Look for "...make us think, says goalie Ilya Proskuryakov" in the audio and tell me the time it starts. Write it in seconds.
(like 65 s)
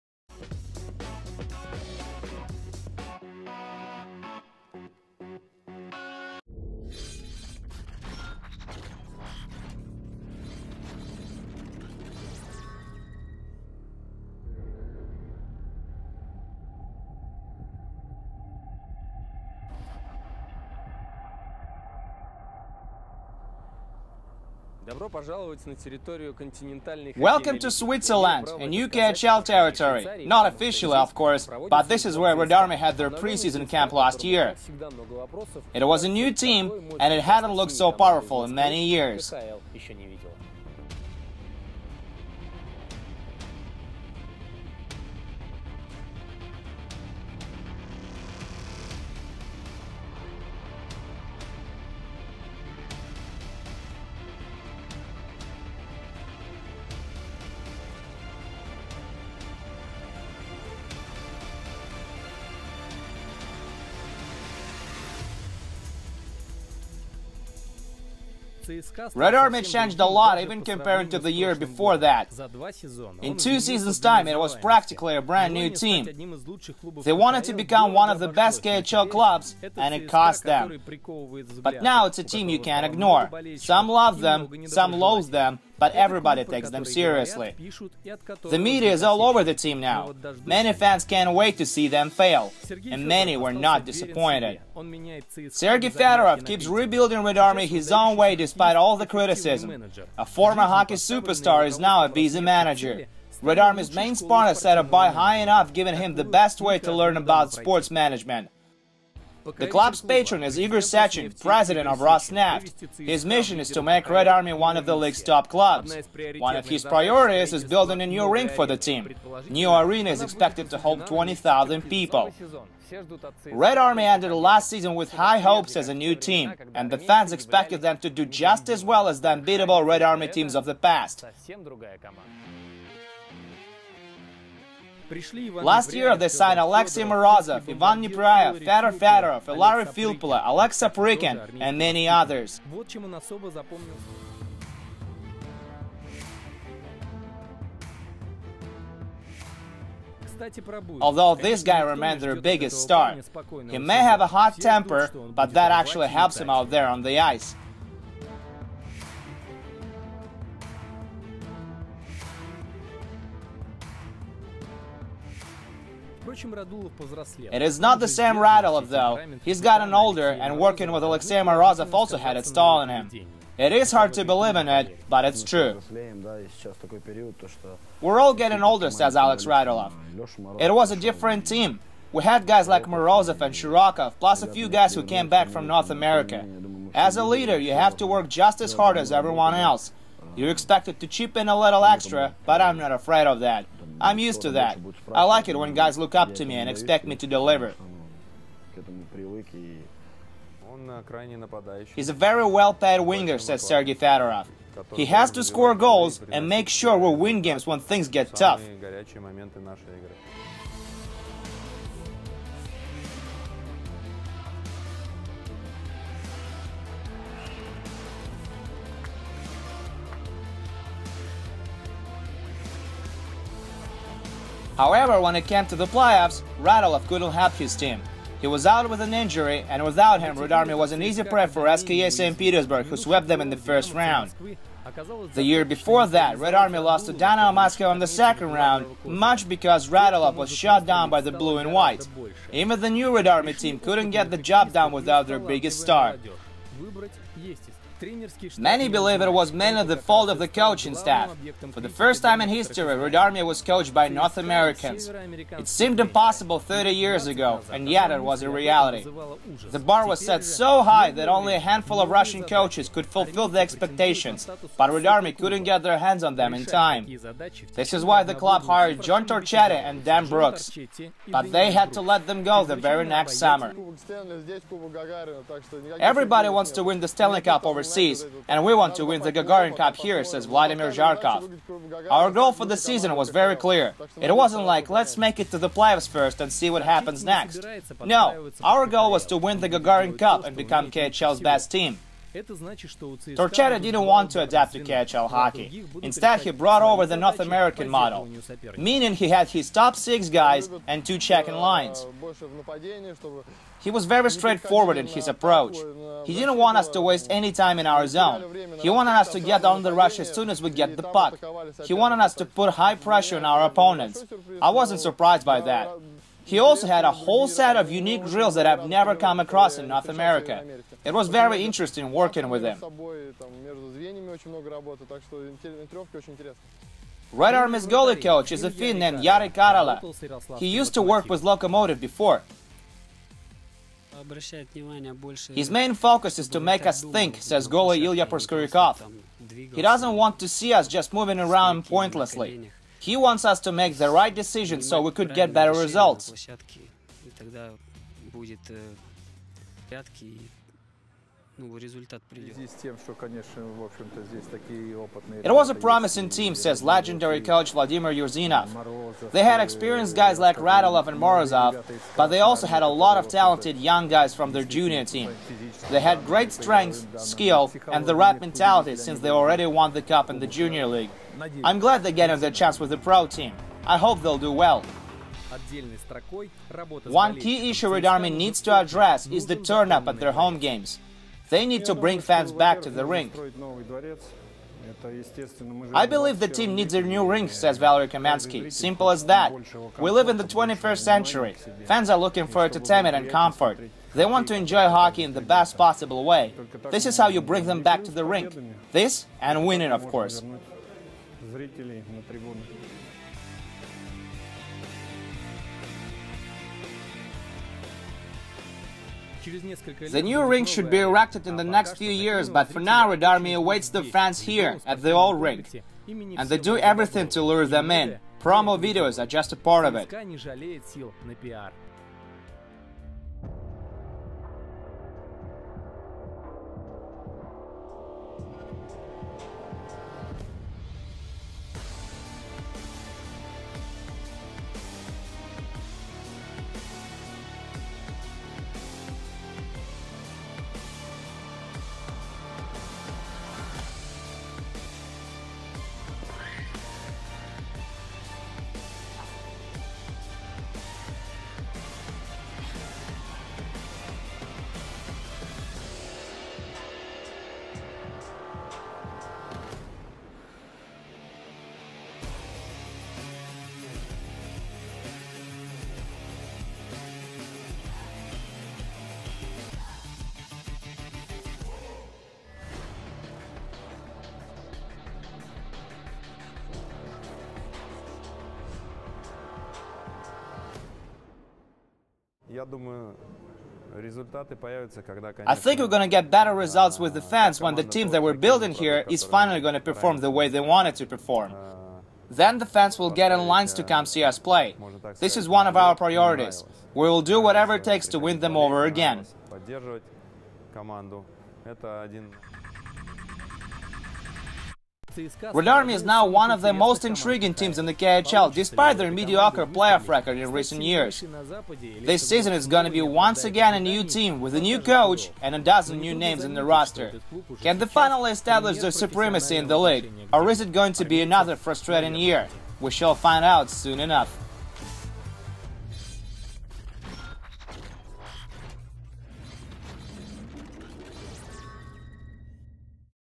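336 s.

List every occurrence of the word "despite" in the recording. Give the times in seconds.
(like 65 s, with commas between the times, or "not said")
98 s, 508 s.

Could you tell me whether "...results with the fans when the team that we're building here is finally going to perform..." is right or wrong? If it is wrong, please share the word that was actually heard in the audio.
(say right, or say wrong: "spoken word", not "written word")
right.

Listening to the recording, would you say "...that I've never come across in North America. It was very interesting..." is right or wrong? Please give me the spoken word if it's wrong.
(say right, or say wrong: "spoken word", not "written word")
right.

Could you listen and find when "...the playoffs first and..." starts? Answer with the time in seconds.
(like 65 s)
285 s.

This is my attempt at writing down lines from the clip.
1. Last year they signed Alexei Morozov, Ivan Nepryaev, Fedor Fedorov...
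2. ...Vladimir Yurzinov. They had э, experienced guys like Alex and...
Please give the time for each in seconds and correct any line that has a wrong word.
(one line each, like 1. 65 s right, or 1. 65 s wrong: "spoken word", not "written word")
1. 135 s right
2. 357 s wrong: "Radulov", not "Alex".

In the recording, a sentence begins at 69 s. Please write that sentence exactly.
Red Army changed a lot even compared to the year before that.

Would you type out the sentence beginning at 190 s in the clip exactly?
You're expected to chip in a little extra, but I'm not afraid of that.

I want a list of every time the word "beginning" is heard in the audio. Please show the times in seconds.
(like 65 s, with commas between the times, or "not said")
not said.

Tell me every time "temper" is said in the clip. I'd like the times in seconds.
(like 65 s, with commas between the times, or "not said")
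154 s.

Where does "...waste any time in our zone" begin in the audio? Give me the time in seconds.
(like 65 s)
307 s.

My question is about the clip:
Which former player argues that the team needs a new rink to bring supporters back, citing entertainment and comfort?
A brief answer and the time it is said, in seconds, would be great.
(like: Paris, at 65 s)
Valery Kamensky, at 387 s.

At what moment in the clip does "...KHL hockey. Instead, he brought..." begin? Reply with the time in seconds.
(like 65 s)
294 s.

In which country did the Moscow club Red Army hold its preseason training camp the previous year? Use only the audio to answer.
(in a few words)
Switzerland.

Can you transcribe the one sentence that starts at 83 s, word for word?
Some love them, some loathe them, but everybody takes them seriously.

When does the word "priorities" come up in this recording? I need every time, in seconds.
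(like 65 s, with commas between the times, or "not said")
116 s, 495 s.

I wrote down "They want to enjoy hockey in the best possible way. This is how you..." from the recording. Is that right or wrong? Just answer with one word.
right.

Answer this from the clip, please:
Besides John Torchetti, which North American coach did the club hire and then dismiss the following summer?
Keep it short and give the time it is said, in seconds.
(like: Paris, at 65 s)
Dan Brooks, at 270 s.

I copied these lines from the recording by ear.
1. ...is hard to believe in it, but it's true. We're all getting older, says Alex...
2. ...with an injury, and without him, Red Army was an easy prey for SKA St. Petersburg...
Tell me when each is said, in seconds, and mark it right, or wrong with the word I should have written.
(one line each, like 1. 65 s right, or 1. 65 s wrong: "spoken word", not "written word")
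1. 173 s right
2. 228 s right.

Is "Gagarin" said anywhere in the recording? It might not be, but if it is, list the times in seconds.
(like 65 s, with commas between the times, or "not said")
279 s, 289 s.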